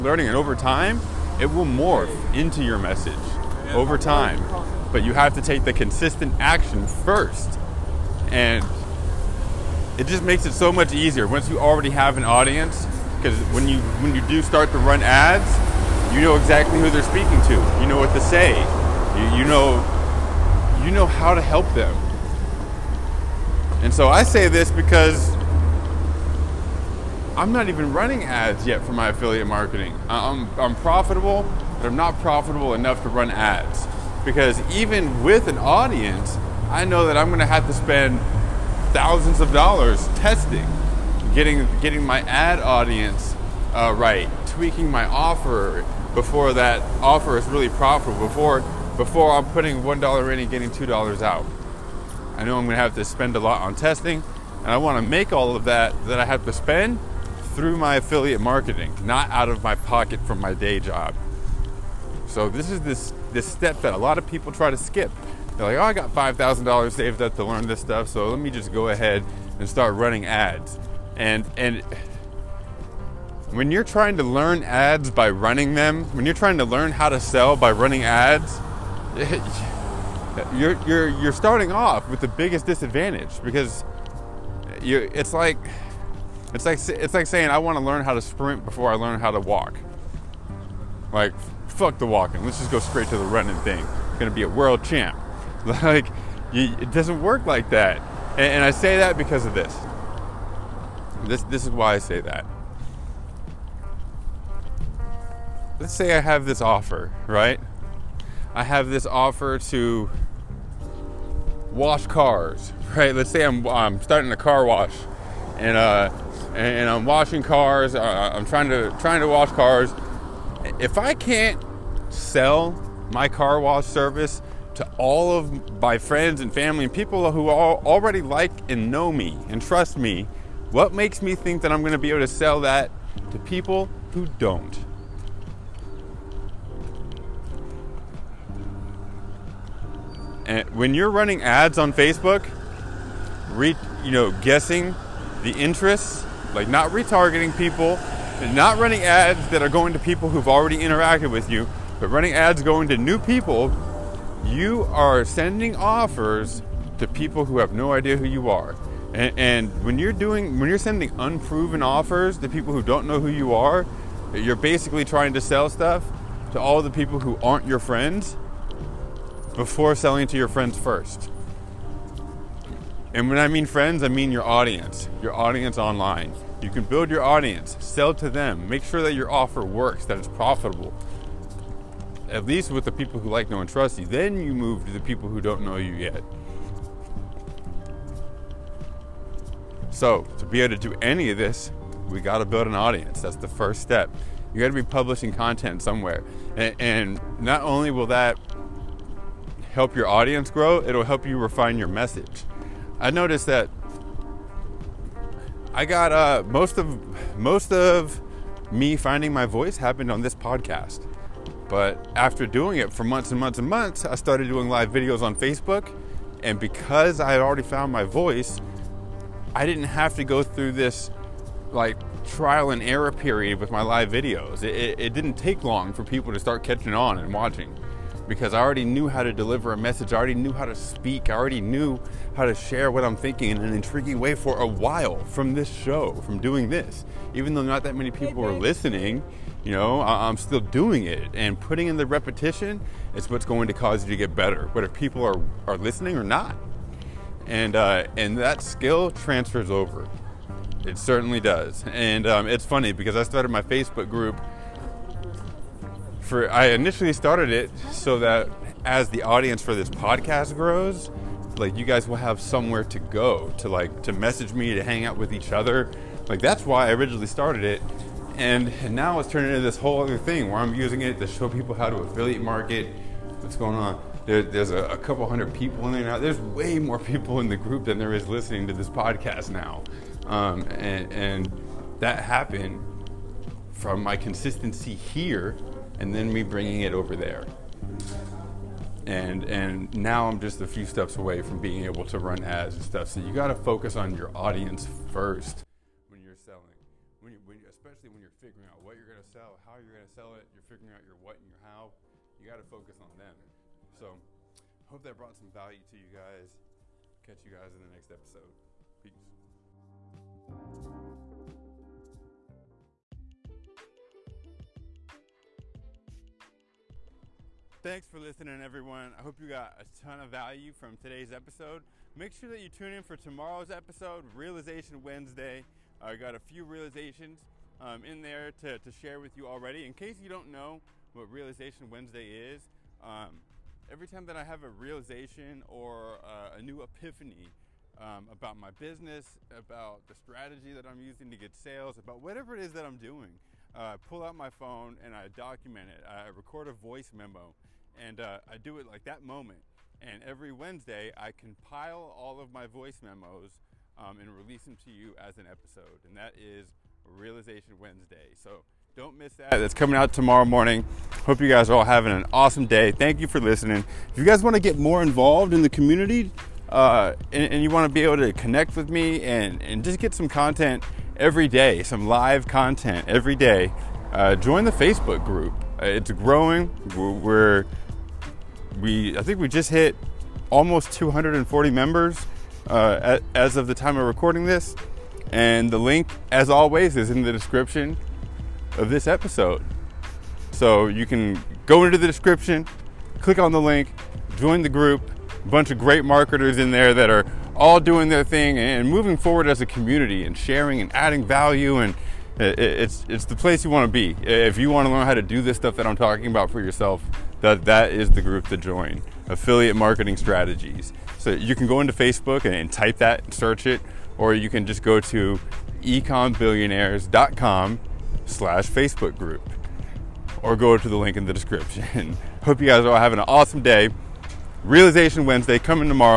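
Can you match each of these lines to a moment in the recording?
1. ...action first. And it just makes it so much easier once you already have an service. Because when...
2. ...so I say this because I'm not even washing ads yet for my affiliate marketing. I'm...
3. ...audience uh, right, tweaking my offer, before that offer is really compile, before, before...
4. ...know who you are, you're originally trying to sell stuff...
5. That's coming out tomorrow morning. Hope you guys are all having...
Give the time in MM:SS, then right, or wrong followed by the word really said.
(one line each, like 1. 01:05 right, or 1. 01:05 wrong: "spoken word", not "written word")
1. 00:06 wrong: "audience", not "service"
2. 00:23 wrong: "running", not "washing"
3. 00:42 wrong: "profitable", not "compile"
4. 02:43 wrong: "basically", not "originally"
5. 05:59 right.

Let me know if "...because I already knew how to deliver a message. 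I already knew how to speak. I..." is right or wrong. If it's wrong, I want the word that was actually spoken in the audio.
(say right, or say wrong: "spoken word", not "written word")
right.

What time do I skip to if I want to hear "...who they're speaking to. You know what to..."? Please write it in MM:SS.
00:16.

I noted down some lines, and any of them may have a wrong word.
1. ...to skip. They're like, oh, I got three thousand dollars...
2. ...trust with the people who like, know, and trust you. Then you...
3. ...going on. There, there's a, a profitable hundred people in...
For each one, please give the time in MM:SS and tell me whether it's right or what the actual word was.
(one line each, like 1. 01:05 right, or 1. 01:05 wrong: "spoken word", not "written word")
1. 01:04 wrong: "five", not "three"
2. 03:02 wrong: "least", not "trust"
3. 04:33 wrong: "couple", not "profitable".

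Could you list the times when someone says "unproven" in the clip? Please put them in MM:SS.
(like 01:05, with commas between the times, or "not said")
02:41.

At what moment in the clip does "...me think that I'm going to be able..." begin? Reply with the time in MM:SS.
02:11.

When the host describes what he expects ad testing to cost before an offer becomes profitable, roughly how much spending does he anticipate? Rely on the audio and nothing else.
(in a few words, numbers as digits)
thousands of dollars.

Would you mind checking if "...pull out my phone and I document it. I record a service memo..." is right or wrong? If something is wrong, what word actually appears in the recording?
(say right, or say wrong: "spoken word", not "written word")
wrong: "voice", not "service".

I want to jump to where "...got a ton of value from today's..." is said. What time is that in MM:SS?
05:19.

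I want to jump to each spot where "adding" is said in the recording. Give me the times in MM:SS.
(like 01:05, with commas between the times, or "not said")
06:40.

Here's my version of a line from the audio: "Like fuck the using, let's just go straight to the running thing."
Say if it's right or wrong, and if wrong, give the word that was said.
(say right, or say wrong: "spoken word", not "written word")
wrong: "walking", not "using".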